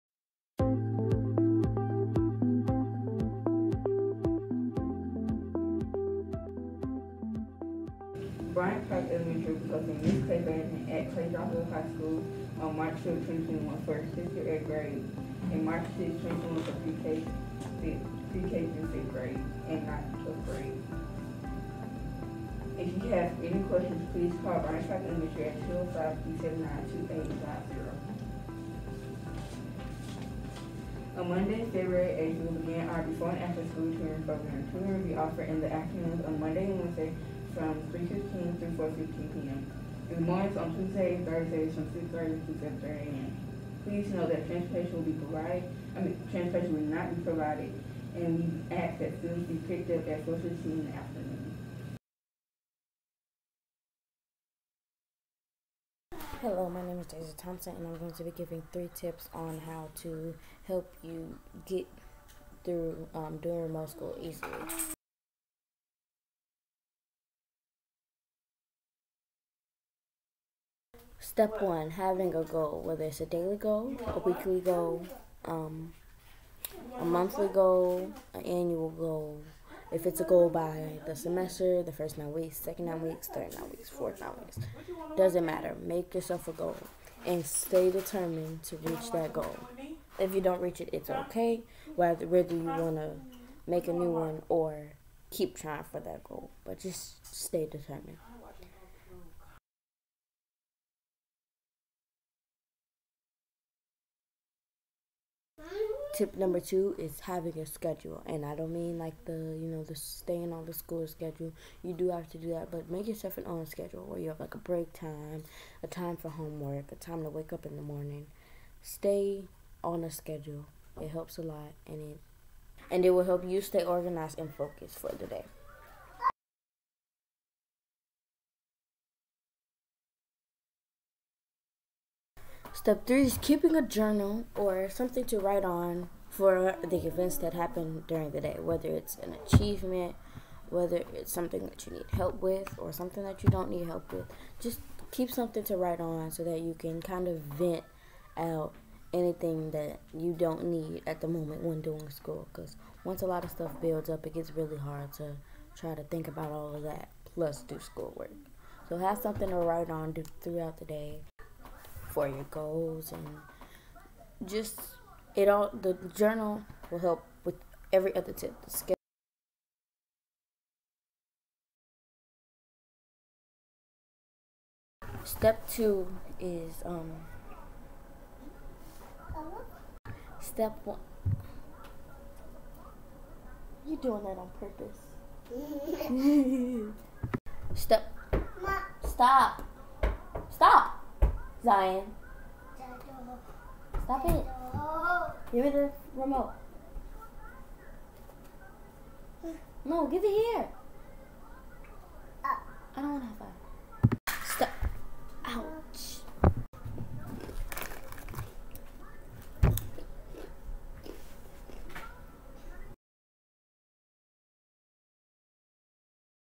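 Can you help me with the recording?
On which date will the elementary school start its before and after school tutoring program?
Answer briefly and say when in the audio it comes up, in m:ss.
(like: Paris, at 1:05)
February 8, at 0:31.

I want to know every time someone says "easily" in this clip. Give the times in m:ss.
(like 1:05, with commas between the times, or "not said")
1:04.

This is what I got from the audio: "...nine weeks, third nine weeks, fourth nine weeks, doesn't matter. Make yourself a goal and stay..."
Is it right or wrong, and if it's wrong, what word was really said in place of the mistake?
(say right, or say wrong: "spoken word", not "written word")
right.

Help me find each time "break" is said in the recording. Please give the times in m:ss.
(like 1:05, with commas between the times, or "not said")
1:54.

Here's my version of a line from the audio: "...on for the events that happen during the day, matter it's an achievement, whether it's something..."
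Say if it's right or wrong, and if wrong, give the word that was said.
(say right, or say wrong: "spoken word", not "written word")
wrong: "whether", not "matter".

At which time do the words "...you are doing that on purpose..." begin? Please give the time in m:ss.
3:03.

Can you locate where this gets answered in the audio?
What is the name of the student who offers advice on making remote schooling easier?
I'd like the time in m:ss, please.
0:57.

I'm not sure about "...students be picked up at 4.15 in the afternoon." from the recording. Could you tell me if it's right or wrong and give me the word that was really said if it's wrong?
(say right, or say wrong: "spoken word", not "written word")
right.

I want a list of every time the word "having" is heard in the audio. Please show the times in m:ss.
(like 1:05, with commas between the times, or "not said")
1:11, 1:47.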